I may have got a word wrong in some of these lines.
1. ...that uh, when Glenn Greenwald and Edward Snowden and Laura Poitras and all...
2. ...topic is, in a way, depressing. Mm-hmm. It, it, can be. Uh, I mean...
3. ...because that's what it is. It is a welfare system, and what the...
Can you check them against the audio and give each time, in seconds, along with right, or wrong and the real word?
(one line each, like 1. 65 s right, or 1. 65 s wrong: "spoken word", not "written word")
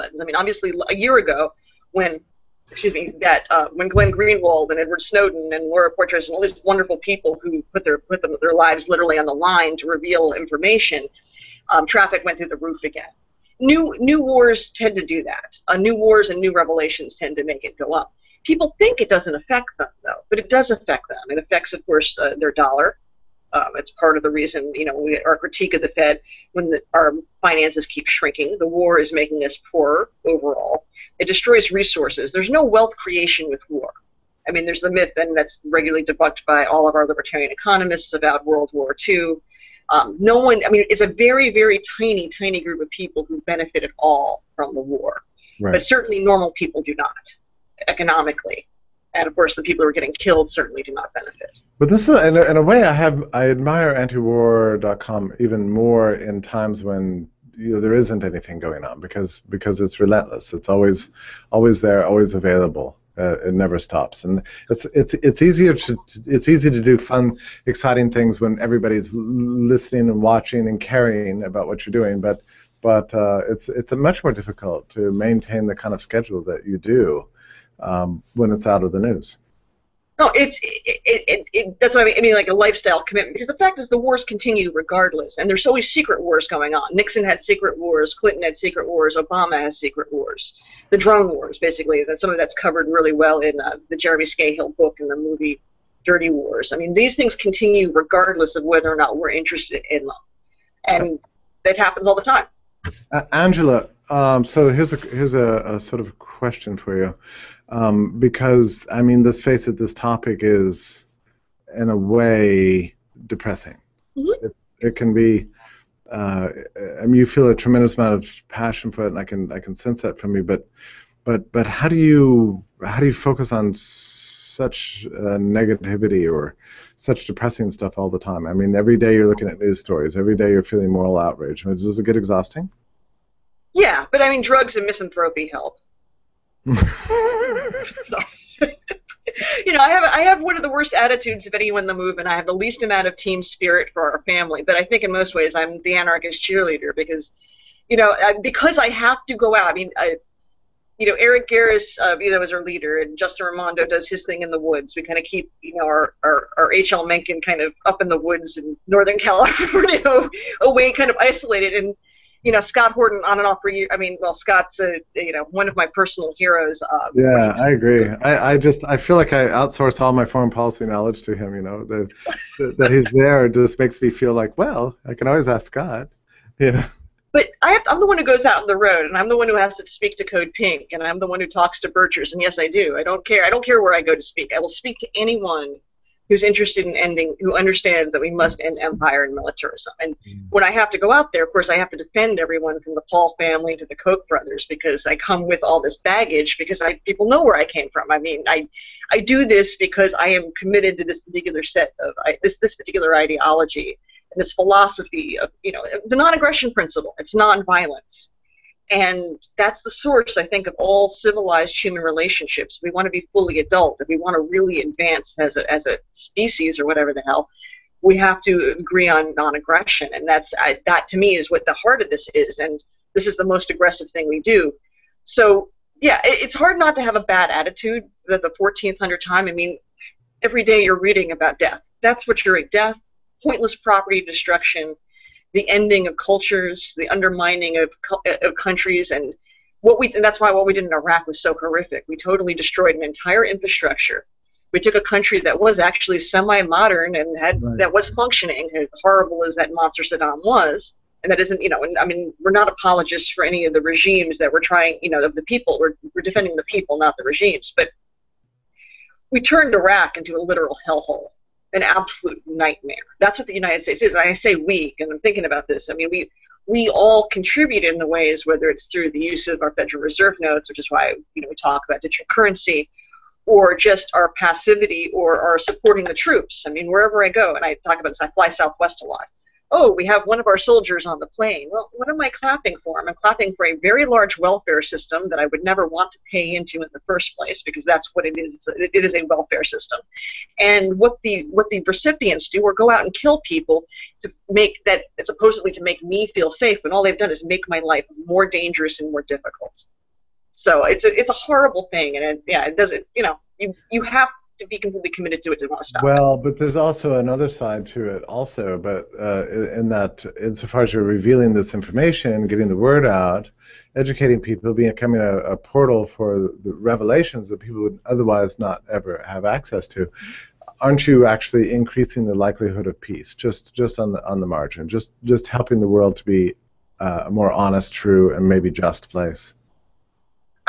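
1. 3 s right
2. 109 s right
3. 287 s right.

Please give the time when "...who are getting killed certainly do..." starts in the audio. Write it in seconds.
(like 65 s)
49 s.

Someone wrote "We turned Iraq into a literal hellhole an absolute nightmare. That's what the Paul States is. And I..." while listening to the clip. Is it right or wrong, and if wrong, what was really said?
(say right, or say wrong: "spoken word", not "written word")
wrong: "United", not "Paul".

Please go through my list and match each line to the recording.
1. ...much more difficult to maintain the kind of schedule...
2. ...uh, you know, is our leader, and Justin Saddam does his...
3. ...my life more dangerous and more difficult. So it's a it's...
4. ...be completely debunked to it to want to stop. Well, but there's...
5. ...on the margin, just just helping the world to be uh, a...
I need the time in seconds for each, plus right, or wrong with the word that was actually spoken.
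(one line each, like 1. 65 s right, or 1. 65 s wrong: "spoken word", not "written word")
1. 73 s right
2. 152 s wrong: "Raimondo", not "Saddam"
3. 297 s right
4. 304 s wrong: "committed", not "debunked"
5. 324 s right.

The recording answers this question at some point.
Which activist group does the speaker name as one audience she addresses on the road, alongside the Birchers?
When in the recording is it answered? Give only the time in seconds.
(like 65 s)
180 s.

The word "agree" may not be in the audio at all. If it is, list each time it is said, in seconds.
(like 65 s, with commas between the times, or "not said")
167 s, 218 s.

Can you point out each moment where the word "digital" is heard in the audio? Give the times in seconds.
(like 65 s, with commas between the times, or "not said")
272 s.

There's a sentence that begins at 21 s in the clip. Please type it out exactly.
It affects, of course, uh, their dollar.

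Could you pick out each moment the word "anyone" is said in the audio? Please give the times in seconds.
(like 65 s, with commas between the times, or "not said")
141 s, 185 s.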